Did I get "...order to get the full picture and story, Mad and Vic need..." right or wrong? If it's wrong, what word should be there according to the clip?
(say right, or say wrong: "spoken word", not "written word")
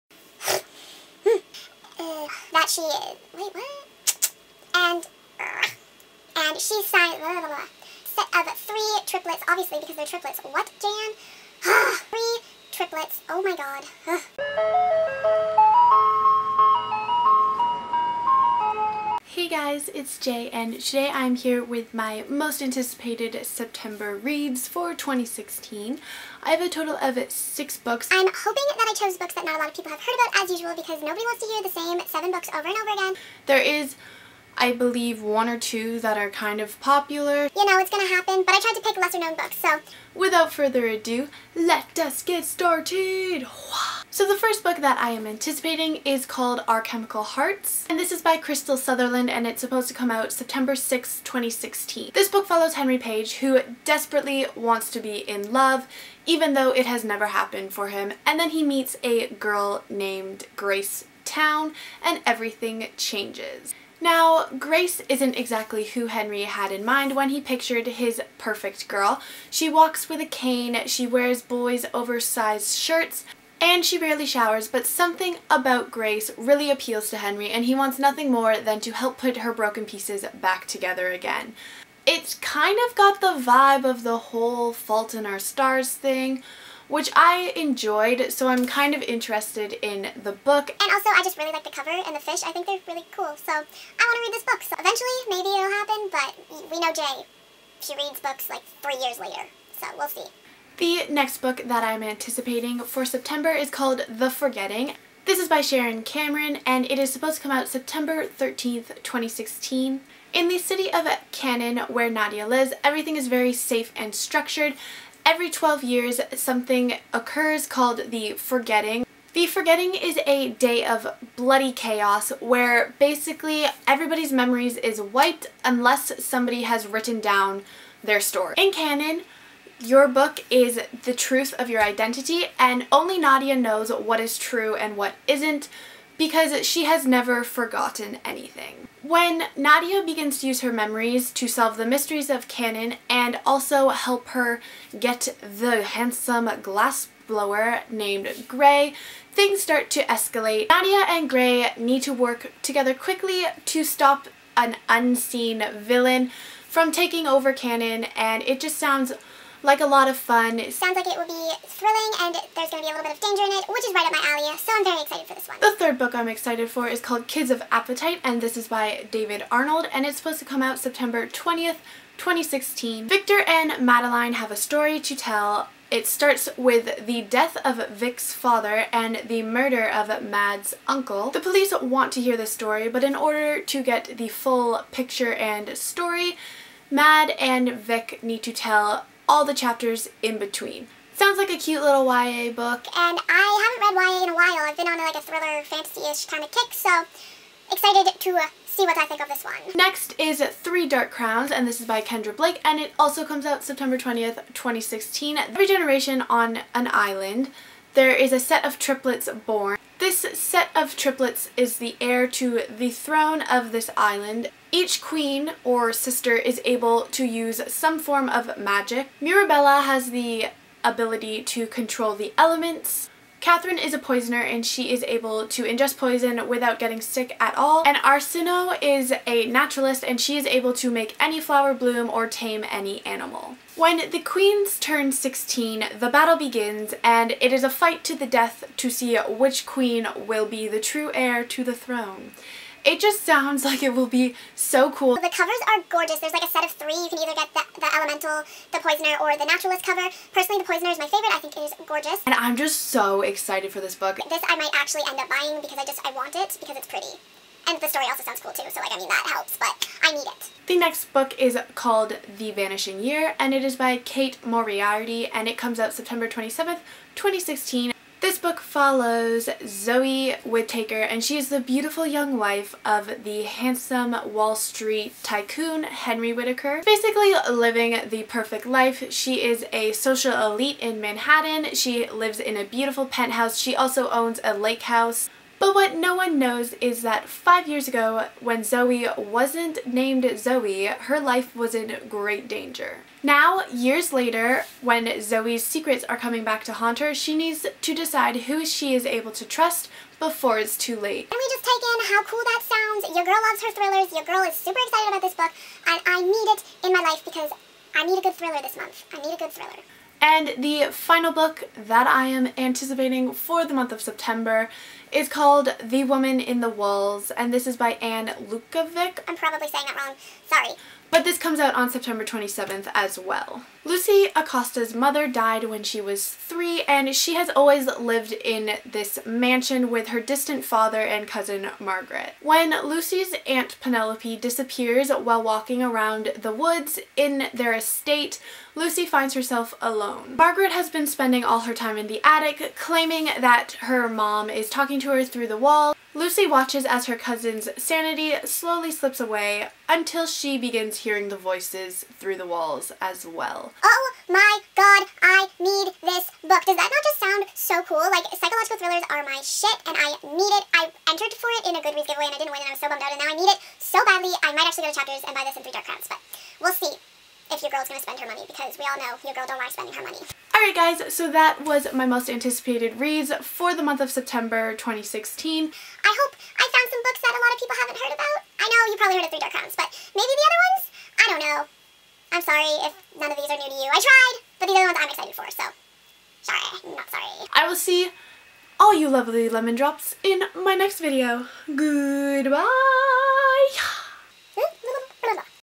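right.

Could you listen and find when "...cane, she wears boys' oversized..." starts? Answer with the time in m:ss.
1:10.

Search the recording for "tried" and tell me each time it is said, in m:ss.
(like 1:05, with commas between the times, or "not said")
0:38, 6:24.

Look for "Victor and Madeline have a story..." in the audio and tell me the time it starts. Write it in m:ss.
2:53.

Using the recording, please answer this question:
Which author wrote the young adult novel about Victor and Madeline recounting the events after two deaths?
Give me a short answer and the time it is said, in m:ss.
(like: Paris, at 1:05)
David Arnold, at 2:49.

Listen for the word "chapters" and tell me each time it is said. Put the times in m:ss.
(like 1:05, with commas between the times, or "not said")
3:09, 6:04.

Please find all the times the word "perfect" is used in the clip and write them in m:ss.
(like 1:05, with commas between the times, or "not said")
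1:08, 4:38.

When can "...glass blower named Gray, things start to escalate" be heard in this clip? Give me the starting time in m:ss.
2:26.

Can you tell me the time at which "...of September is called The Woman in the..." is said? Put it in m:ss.
5:13.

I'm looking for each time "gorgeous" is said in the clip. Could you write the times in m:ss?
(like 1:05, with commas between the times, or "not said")
4:05, 4:11.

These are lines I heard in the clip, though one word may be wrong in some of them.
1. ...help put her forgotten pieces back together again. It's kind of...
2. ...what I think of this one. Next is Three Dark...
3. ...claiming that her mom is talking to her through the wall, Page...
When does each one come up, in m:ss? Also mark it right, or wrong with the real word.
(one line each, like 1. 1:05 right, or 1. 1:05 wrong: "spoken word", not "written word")
1. 1:18 wrong: "broken", not "forgotten"
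2. 3:18 right
3. 5:42 wrong: "Lucy", not "Page".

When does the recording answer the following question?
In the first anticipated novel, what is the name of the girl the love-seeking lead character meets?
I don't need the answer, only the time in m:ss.
1:00.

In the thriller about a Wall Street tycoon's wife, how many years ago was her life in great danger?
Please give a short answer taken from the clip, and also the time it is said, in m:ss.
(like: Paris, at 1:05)
5, at 4:47.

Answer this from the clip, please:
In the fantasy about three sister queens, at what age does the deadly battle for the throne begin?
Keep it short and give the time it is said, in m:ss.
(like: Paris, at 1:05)
16, at 3:55.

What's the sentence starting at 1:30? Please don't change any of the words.
And also, I just really like the cover and the fish.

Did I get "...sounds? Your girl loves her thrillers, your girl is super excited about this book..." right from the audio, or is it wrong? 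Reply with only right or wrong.
right.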